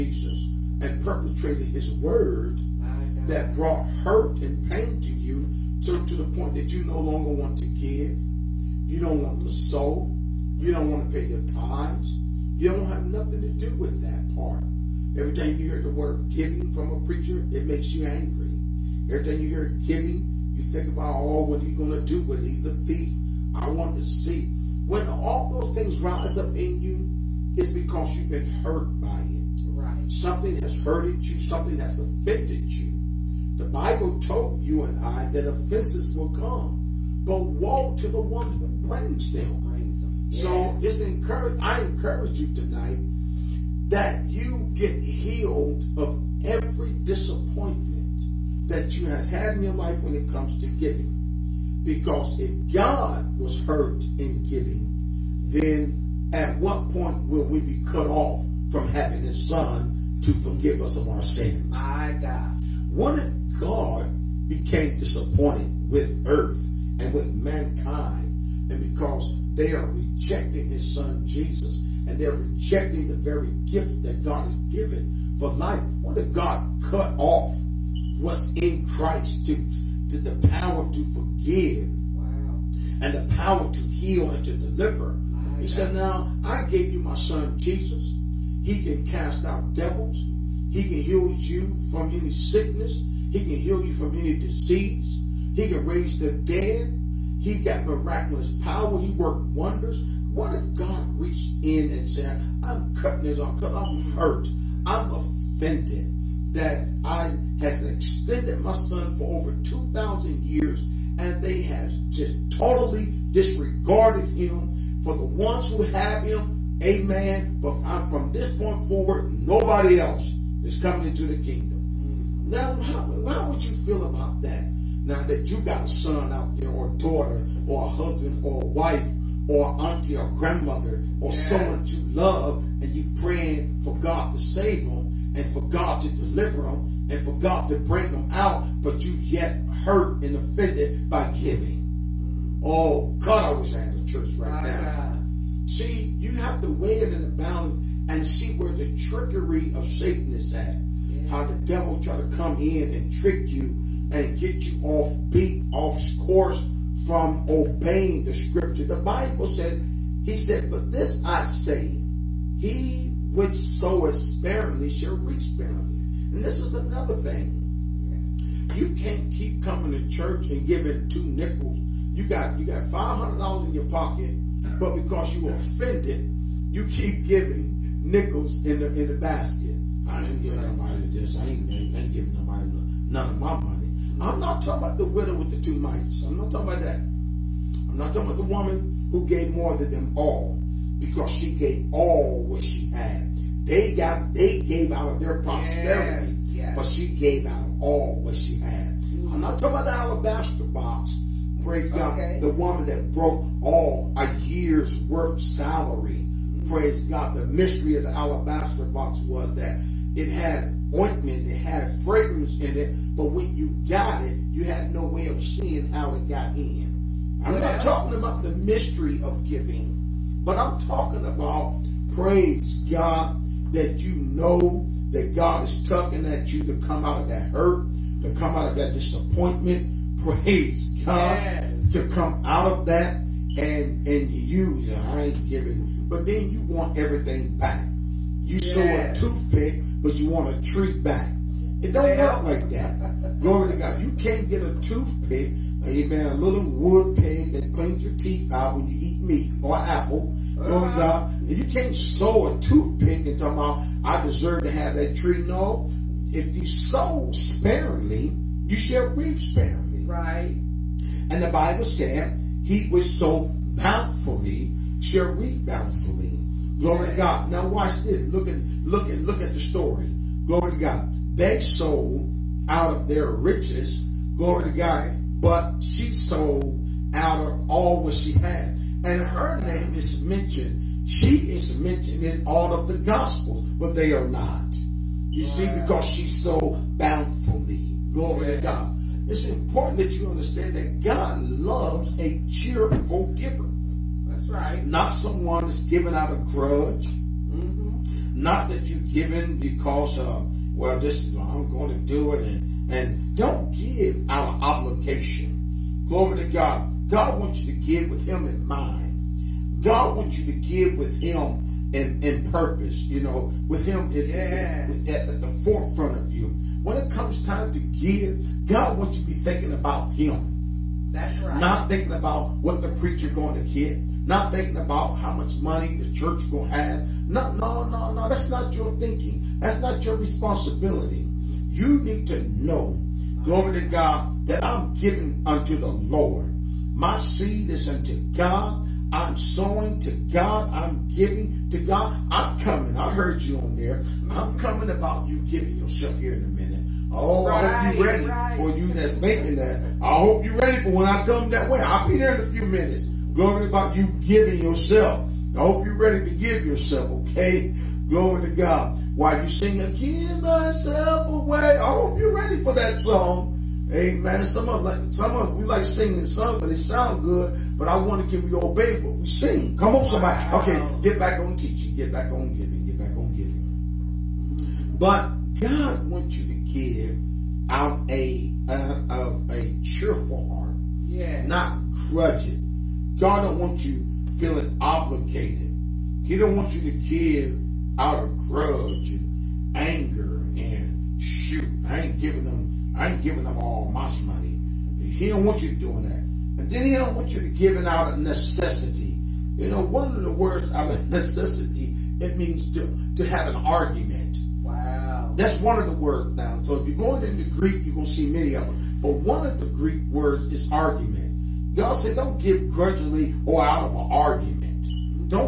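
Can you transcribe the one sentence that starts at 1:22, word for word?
and the power to heal and to deliver.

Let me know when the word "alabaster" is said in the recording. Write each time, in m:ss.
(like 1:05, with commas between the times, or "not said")
3:19, 3:28.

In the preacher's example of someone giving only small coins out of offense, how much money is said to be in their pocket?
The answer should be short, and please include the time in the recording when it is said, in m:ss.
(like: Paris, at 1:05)
$500, at 2:52.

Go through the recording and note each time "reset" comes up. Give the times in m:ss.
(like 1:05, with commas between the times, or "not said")
not said.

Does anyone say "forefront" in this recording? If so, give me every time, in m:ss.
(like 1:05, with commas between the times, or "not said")
5:15.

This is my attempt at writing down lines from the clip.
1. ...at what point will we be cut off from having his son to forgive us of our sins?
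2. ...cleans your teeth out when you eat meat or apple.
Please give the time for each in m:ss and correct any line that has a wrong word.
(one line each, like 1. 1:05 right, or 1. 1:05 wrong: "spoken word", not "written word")
1. 0:56 right
2. 4:07 right.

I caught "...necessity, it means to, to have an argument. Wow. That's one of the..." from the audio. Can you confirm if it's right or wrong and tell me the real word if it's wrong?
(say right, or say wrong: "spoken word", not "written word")
right.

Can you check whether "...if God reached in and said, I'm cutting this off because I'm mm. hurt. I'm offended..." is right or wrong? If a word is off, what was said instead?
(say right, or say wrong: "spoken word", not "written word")
right.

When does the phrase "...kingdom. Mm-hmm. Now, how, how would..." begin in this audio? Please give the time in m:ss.
2:01.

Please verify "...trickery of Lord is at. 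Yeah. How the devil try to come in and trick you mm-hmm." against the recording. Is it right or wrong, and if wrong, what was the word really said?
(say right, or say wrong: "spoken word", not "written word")
wrong: "Satan", not "Lord".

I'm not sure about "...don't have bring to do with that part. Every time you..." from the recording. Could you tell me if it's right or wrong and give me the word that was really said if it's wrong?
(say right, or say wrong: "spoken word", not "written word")
wrong: "nothing", not "bring".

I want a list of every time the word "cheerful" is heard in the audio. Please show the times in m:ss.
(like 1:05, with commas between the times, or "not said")
4:52, 6:19.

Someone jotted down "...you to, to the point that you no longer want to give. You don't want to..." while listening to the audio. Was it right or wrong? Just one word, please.
right.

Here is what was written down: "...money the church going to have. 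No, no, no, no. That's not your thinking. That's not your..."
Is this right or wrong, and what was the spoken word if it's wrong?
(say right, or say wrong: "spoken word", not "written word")
right.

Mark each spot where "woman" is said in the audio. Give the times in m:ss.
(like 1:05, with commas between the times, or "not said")
3:08, 3:22.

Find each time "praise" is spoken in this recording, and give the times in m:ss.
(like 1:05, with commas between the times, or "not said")
3:21, 3:26, 3:42, 3:50.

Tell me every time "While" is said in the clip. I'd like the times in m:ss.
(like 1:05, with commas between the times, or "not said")
5:59.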